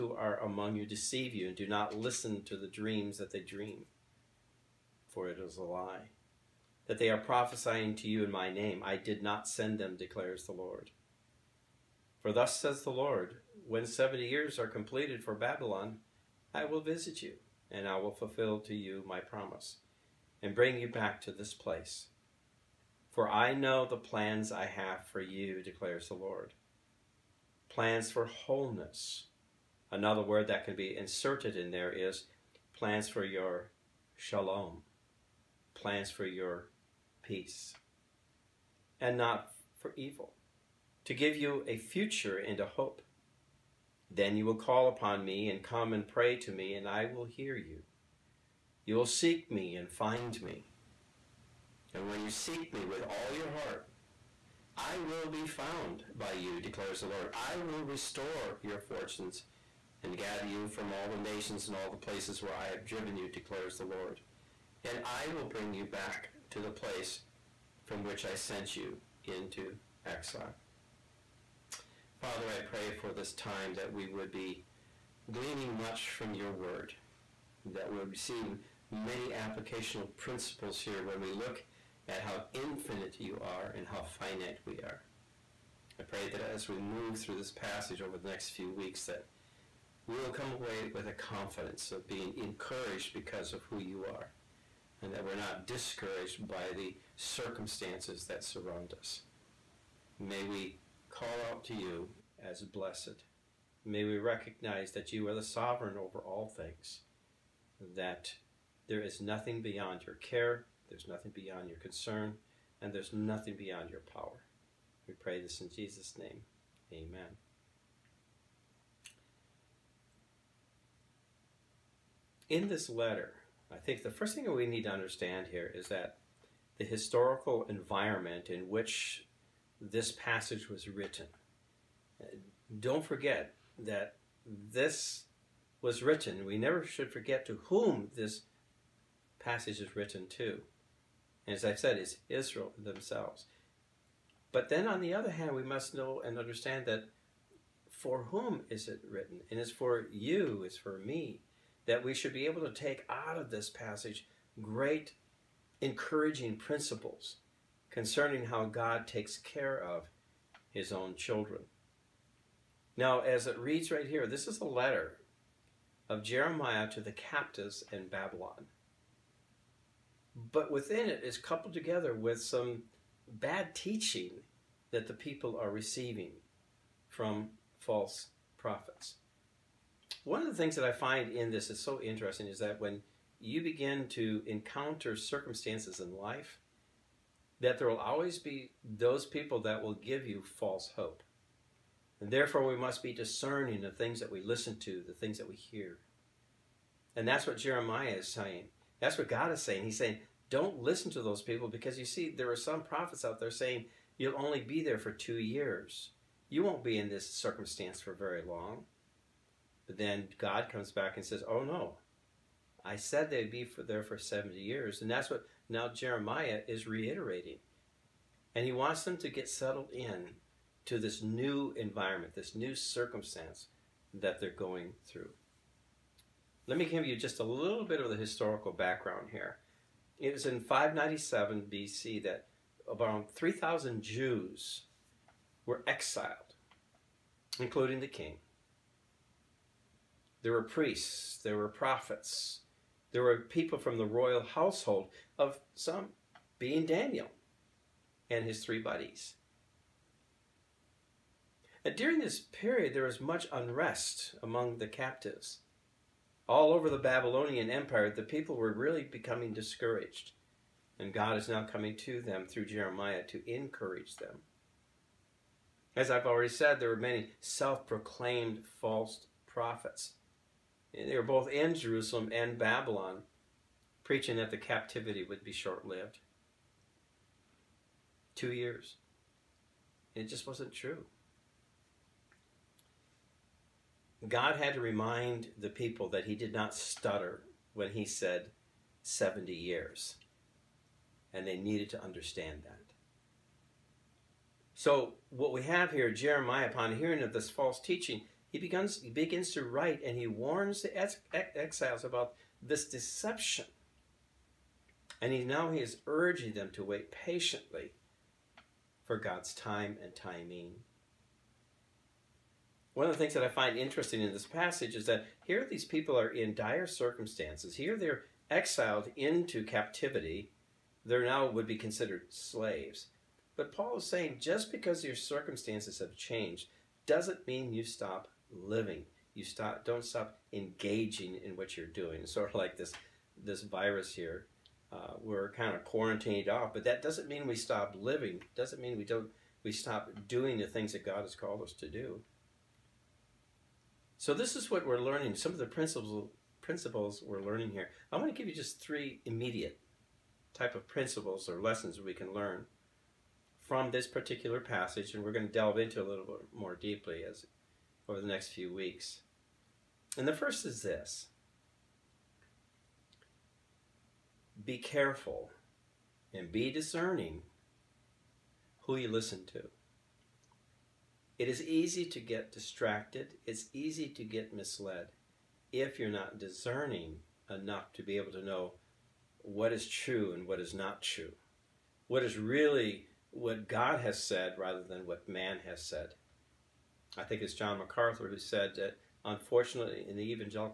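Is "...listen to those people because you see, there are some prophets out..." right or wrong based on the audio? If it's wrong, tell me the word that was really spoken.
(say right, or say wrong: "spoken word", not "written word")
right.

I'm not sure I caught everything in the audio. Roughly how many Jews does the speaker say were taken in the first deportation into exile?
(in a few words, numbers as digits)
3,000.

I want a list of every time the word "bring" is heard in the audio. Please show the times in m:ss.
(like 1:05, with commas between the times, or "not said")
0:20, 1:05.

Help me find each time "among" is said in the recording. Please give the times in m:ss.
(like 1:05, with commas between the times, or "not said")
0:00, 4:14.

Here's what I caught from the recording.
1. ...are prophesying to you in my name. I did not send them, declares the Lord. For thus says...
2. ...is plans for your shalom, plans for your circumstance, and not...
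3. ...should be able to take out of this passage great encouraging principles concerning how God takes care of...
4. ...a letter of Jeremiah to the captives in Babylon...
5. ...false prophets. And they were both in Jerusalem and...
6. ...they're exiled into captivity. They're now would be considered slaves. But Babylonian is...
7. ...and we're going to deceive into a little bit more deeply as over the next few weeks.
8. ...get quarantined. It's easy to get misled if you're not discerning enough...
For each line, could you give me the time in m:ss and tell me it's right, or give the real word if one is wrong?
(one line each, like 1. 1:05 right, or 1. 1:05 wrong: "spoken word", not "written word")
1. 0:07 right
2. 0:31 wrong: "peace", not "circumstance"
3. 2:32 right
4. 2:44 right
5. 4:28 right
6. 5:17 wrong: "Paul", not "Babylonian"
7. 5:55 wrong: "delve", not "deceive"
8. 6:12 wrong: "distracted", not "quarantined".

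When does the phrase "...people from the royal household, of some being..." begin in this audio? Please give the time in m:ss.
4:03.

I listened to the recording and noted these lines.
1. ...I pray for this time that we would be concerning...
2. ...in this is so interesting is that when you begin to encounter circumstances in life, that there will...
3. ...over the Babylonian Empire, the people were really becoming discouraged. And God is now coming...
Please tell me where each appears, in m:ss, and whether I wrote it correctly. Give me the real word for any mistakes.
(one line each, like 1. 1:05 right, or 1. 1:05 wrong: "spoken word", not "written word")
1. 1:12 wrong: "gleaning", not "concerning"
2. 3:01 right
3. 4:16 right.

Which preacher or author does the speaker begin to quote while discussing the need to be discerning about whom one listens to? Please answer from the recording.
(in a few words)
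John MacArthur.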